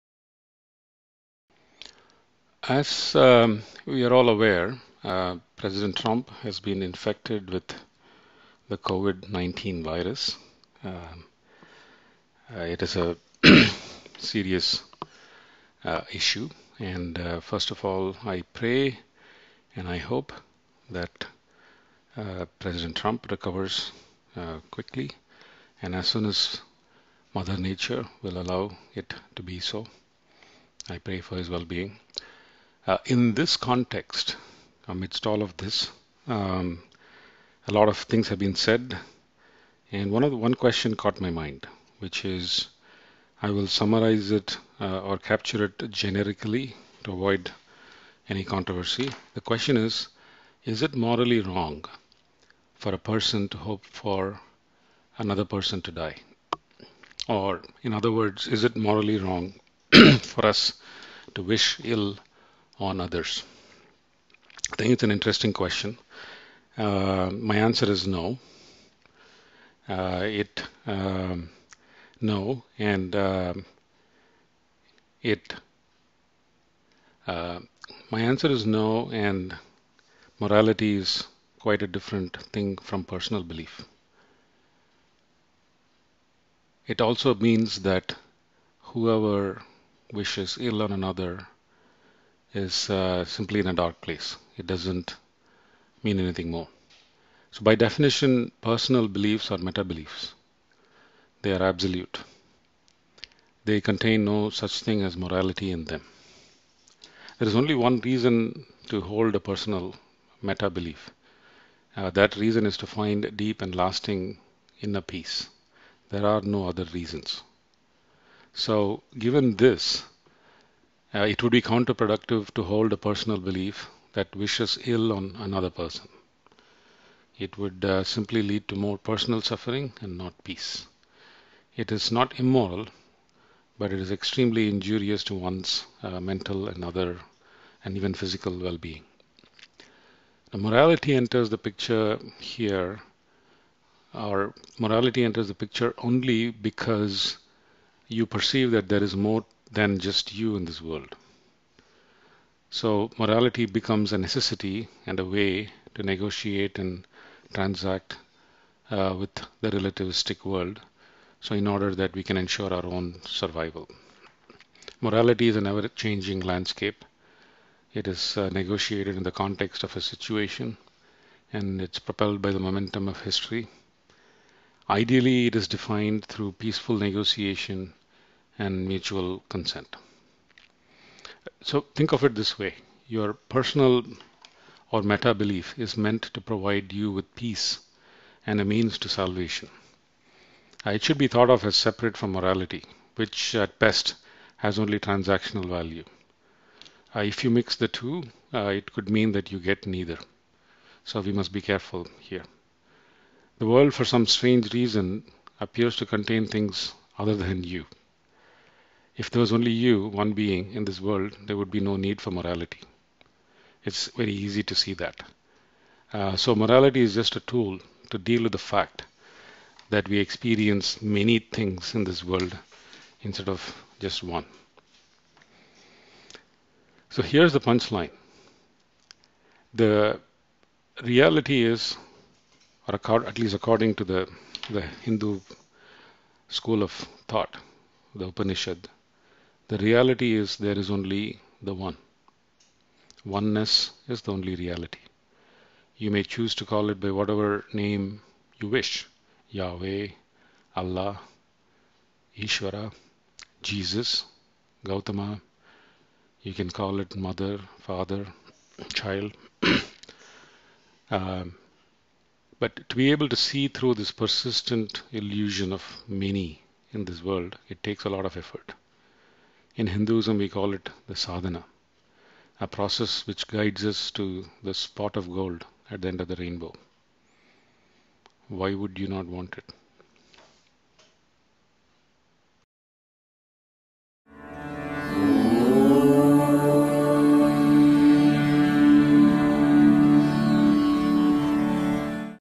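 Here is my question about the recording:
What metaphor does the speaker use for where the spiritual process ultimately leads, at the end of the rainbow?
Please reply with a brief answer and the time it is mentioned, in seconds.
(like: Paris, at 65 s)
Spot of gold, at 274 s.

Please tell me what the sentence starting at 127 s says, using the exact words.
It would uh, simply lead to more personal suffering and not peace.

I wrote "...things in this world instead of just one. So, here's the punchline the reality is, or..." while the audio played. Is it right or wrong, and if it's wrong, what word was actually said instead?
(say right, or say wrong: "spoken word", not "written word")
right.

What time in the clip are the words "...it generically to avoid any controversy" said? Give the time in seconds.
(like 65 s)
45 s.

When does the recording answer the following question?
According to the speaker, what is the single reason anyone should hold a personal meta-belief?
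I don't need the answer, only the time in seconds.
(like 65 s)
113 s.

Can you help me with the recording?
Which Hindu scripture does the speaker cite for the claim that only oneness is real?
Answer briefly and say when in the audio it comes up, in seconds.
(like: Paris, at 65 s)
The Upanishad, at 238 s.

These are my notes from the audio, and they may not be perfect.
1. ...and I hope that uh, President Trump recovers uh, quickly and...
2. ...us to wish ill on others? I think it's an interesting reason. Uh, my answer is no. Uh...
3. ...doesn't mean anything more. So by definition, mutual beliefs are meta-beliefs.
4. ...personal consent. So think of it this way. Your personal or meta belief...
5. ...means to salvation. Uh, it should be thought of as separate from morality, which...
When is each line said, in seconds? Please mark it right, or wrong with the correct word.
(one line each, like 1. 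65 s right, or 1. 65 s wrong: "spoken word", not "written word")
1. 19 s right
2. 60 s wrong: "question", not "reason"
3. 94 s wrong: "personal", not "mutual"
4. 178 s wrong: "mutual", not "personal"
5. 188 s right.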